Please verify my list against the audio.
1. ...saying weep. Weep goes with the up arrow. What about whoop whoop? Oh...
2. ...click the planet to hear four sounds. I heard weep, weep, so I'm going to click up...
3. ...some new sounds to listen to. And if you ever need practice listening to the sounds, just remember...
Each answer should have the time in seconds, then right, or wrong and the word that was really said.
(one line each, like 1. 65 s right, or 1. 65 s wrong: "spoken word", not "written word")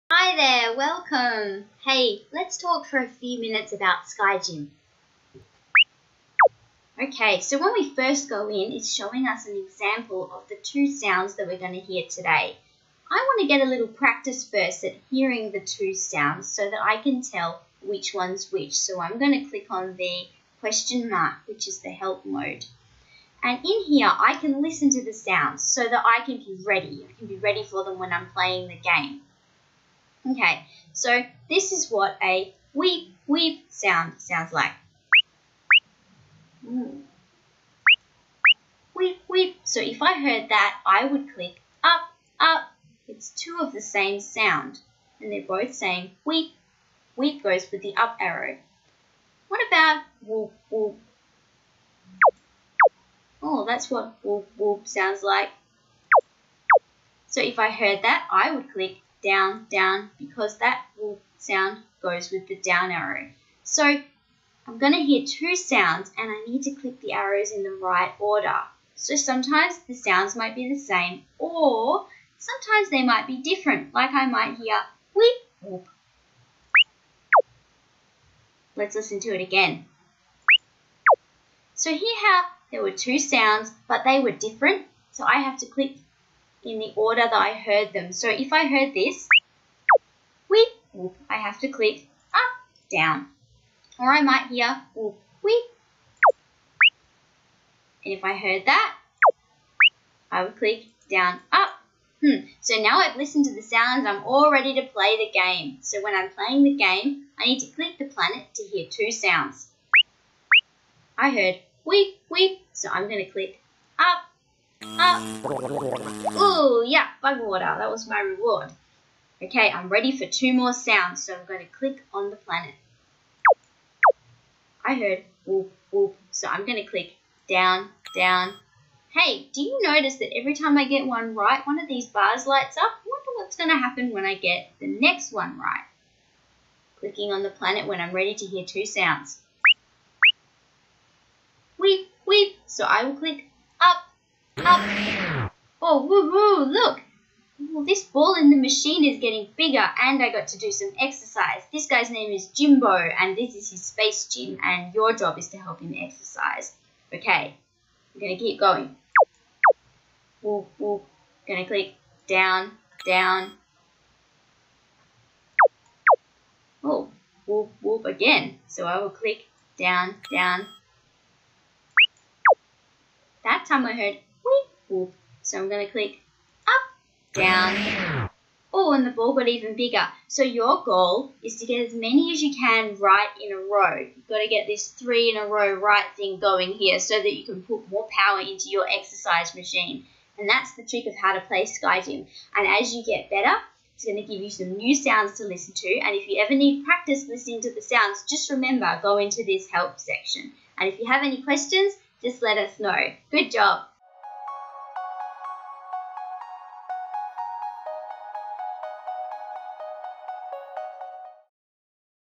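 1. 45 s right
2. 107 s wrong: "two", not "four"
3. 194 s right.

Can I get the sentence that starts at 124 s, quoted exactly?
I heard whoop, whoop, so I'm going to click down, down.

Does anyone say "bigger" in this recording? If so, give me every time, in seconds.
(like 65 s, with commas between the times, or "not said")
149 s, 179 s.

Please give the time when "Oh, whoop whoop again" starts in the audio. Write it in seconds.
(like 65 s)
166 s.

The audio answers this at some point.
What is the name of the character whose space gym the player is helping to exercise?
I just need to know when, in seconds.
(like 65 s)
152 s.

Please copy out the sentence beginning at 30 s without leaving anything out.
Okay, so this is what a weep weep sound sounds like.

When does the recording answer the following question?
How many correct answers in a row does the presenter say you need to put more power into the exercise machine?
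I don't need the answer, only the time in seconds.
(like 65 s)
184 s.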